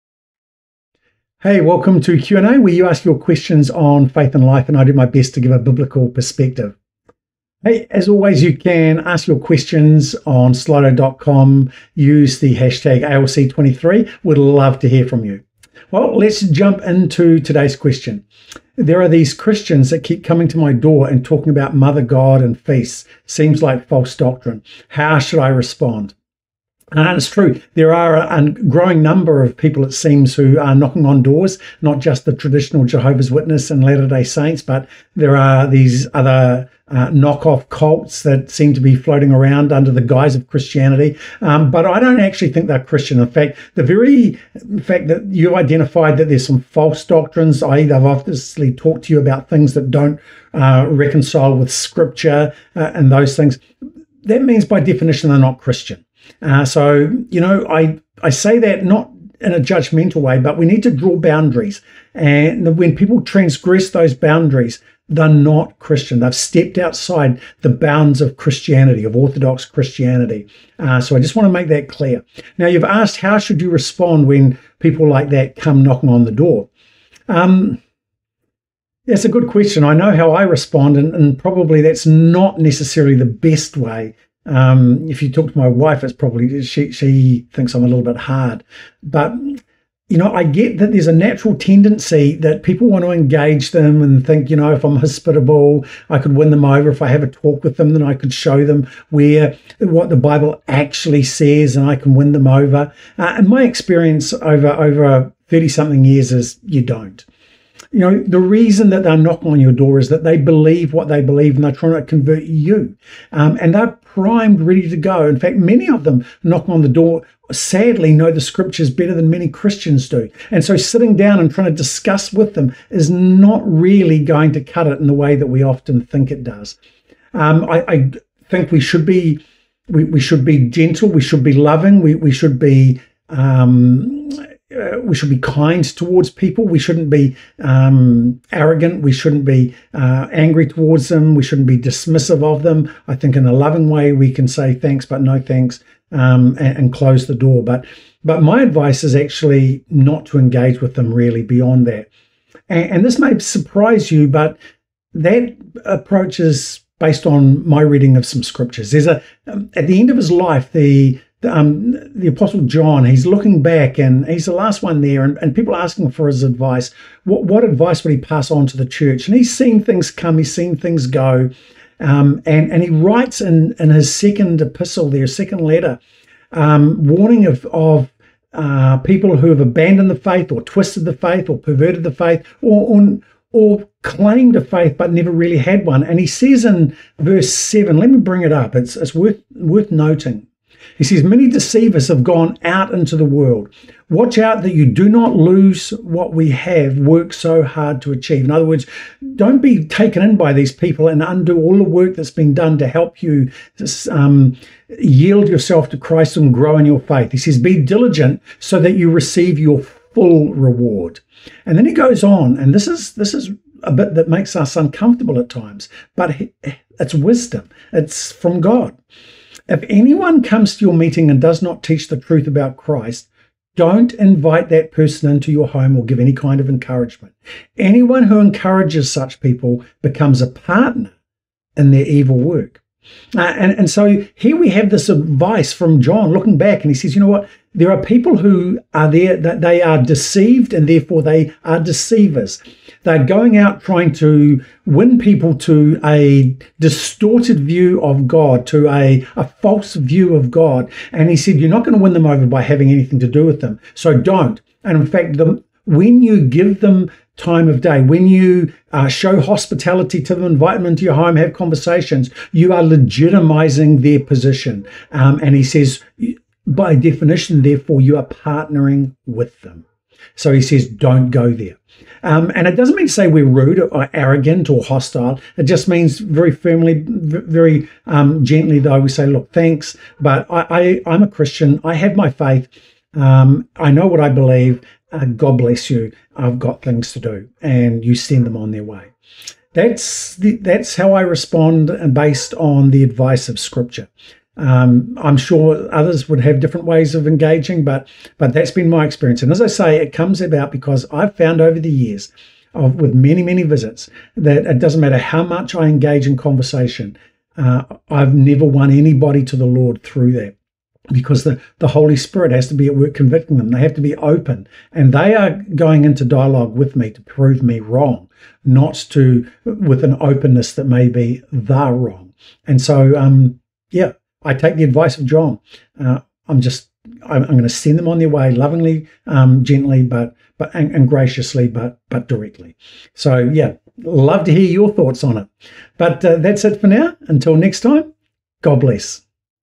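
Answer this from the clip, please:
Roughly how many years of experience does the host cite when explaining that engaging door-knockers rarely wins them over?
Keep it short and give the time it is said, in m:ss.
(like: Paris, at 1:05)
Thirty something years, at 1:45.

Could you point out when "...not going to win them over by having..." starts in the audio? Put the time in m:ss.
4:11.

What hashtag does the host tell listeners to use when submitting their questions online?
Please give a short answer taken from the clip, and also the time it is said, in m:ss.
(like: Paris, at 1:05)
ALC23, at 0:13.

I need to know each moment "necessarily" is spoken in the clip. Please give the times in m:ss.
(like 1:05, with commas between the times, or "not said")
1:22.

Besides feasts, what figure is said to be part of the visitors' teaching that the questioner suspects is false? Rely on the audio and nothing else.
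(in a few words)
Mother God.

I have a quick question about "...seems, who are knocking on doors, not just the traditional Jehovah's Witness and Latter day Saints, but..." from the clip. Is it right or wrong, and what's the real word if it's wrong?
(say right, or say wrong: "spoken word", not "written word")
right.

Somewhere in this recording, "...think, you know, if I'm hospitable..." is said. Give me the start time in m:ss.
1:34.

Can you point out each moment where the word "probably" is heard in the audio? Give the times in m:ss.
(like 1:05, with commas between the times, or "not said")
1:21, 1:26.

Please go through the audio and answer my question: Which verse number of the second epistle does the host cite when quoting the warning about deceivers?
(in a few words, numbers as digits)
7.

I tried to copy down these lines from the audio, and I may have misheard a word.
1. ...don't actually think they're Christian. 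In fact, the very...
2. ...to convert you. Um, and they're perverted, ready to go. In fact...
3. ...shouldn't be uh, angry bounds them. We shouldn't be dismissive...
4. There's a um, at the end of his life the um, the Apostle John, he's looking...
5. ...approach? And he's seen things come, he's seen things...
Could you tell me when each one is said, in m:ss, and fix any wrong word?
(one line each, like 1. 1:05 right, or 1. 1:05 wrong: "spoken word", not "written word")
1. 0:42 right
2. 1:51 wrong: "primed", not "perverted"
3. 2:19 wrong: "towards", not "bounds"
4. 2:38 right
5. 2:48 wrong: "church", not "approach".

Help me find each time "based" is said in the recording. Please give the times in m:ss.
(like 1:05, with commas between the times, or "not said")
2:36, 4:52.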